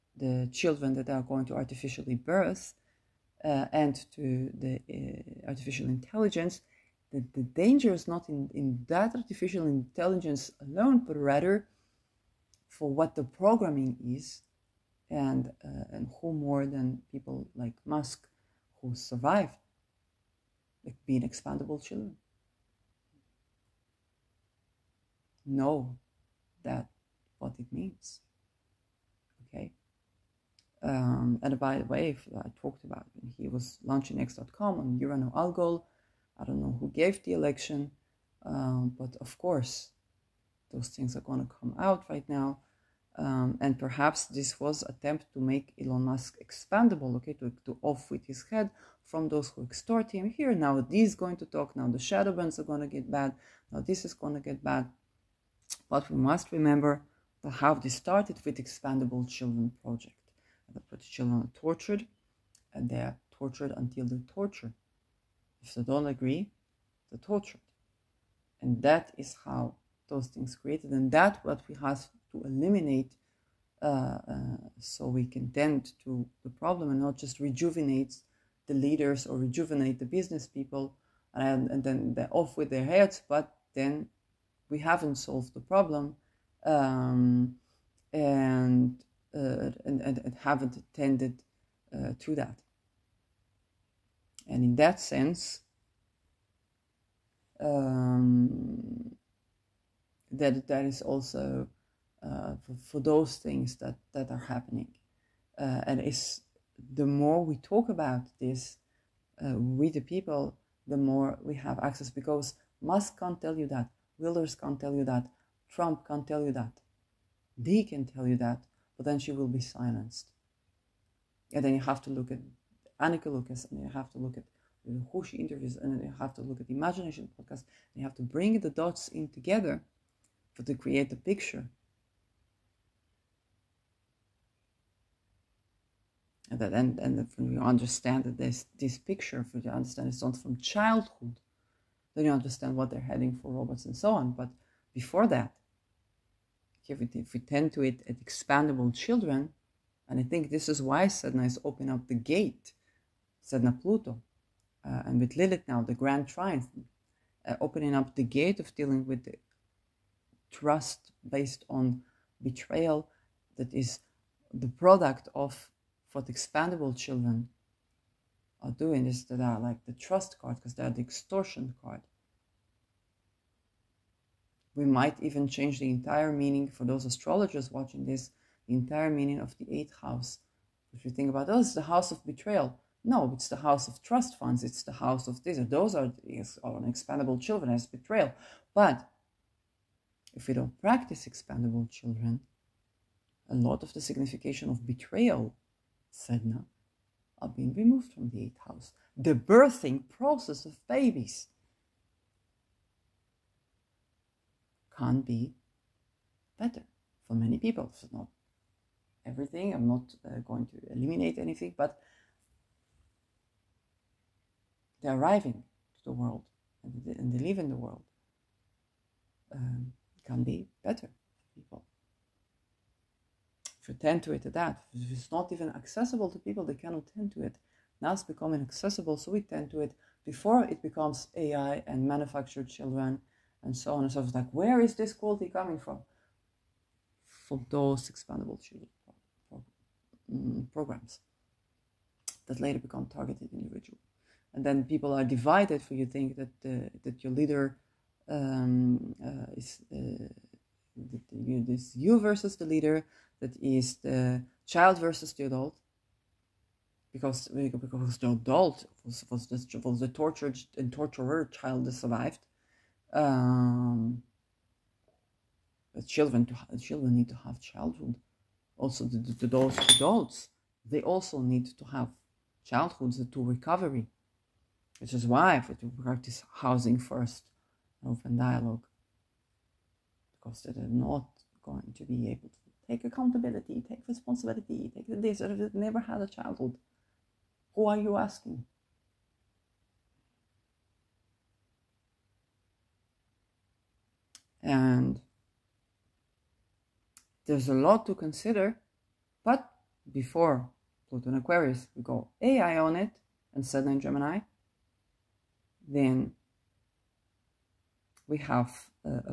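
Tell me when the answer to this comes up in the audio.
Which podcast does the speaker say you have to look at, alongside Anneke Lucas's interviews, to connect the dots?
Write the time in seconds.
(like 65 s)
126 s.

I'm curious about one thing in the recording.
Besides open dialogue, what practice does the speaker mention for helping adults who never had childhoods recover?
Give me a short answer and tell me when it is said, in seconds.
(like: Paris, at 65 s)
housing first, at 276 s.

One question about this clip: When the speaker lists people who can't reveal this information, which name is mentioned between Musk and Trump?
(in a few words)
Wilders.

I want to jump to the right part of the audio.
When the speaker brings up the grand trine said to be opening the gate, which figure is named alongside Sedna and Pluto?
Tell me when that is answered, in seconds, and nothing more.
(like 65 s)
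155 s.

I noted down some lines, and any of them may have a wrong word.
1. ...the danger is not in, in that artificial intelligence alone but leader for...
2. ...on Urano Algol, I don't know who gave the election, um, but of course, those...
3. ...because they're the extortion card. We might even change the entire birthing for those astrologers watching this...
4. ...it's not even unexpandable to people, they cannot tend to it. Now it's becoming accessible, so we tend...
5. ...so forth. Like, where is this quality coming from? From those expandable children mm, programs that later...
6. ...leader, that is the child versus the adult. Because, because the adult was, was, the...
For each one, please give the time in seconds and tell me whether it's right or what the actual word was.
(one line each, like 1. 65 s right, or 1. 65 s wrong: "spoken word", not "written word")
1. 7 s wrong: "rather", not "leader"
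2. 34 s right
3. 170 s wrong: "meaning", not "birthing"
4. 225 s wrong: "accessible", not "unexpandable"
5. 234 s right
6. 252 s right.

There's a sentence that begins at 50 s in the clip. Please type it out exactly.
Here now, this is going to talk.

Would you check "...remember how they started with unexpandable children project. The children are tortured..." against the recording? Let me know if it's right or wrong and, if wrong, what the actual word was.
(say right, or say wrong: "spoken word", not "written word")
wrong: "expandable", not "unexpandable".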